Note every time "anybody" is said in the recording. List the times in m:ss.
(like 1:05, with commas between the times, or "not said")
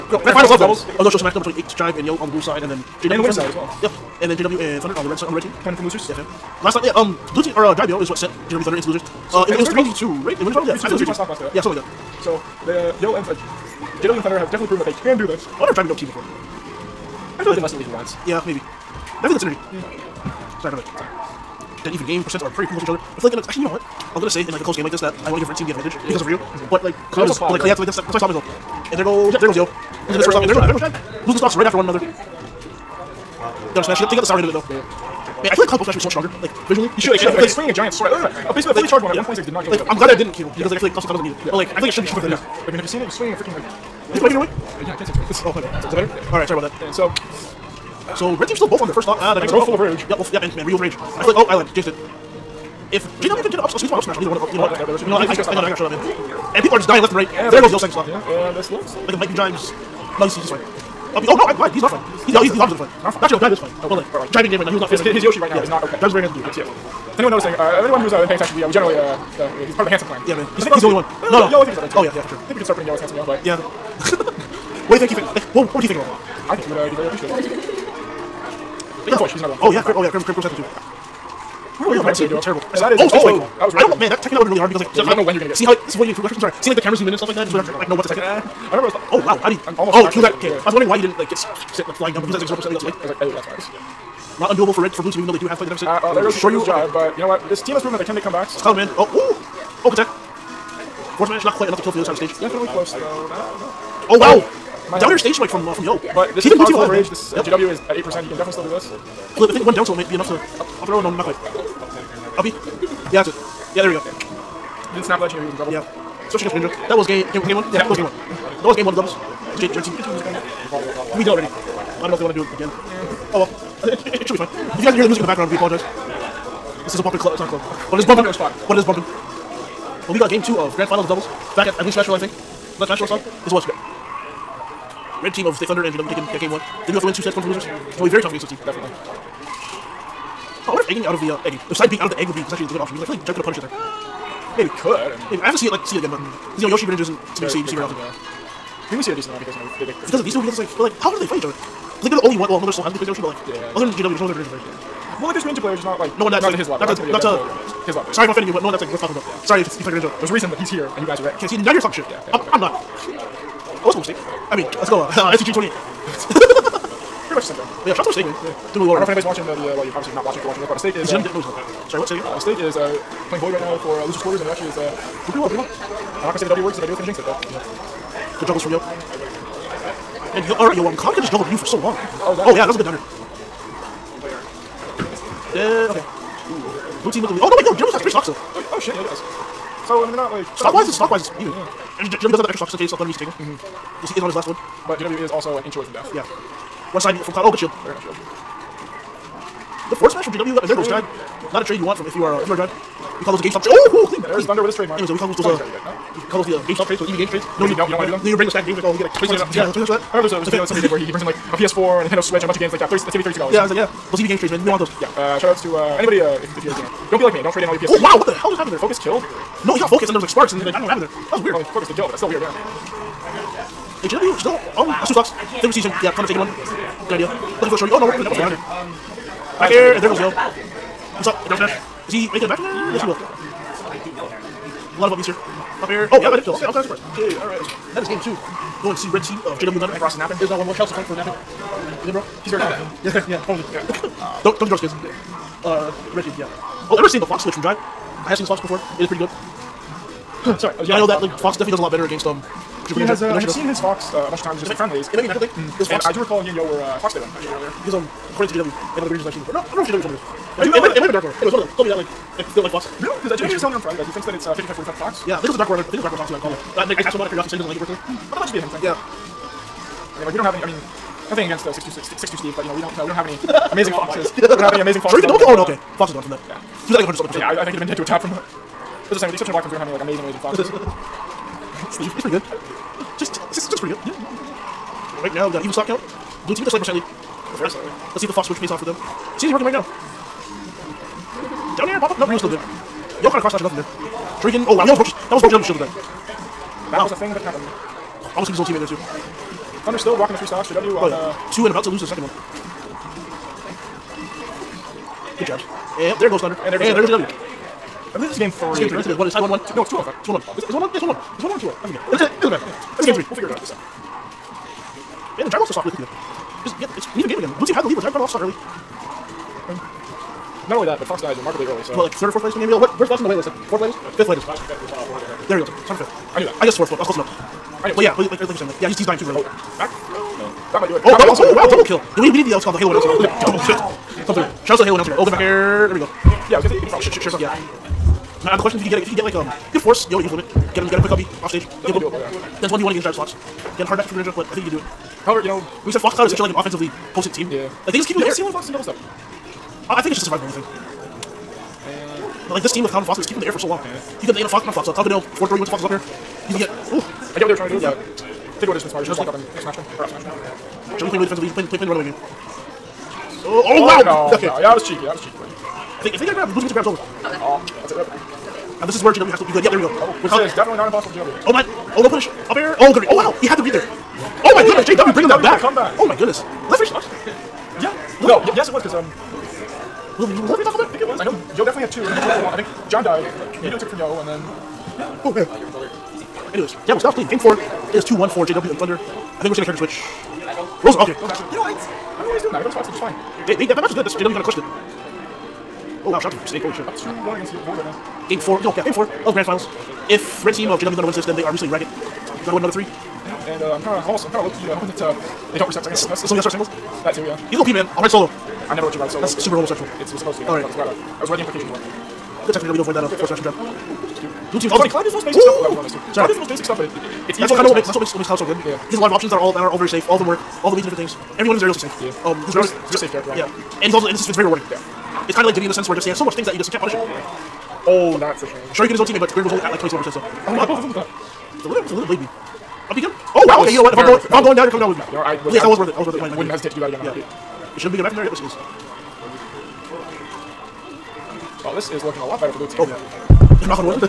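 2:49, 3:35.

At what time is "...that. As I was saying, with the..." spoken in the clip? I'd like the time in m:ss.
4:38.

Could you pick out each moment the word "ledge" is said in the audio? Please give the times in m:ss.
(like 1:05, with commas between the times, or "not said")
1:55.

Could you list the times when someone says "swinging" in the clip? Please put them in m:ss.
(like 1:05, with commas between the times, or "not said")
0:37, 0:43.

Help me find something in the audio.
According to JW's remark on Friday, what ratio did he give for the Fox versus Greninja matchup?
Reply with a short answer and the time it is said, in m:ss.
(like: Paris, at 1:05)
55-45, at 4:24.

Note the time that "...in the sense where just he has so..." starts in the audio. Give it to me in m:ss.
7:05.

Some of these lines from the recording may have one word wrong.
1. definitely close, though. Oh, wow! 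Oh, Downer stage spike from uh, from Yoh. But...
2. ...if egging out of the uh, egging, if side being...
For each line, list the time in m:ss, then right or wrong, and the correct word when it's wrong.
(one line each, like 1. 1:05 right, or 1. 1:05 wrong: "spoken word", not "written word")
1. 1:42 right
2. 2:20 right.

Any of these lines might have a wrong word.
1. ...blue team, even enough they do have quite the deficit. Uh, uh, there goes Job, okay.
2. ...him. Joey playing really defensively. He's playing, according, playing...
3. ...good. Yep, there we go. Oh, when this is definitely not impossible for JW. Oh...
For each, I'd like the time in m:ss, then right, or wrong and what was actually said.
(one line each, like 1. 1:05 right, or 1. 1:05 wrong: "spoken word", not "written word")
1. 1:35 wrong: "though", not "enough"
2. 6:00 wrong: "playing", not "according"
3. 6:09 right.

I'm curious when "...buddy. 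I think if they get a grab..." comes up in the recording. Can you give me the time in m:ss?
6:05.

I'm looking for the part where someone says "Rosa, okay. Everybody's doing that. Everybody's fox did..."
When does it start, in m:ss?
6:30.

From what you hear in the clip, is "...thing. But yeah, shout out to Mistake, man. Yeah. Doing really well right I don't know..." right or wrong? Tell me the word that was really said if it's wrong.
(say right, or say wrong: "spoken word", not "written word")
right.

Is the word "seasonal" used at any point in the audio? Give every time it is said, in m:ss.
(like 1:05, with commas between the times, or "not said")
not said.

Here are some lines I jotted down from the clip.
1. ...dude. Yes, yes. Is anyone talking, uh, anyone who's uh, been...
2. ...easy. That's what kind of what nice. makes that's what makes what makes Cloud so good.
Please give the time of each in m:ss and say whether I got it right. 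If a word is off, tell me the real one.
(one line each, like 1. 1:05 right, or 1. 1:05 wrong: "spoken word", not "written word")
1. 1:06 wrong: "noticing", not "talking"
2. 6:57 right.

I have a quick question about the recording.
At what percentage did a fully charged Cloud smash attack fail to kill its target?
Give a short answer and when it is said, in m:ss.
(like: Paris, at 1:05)
126, at 0:39.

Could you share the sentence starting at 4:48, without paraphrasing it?
Let's see if the fox switch pays off for them.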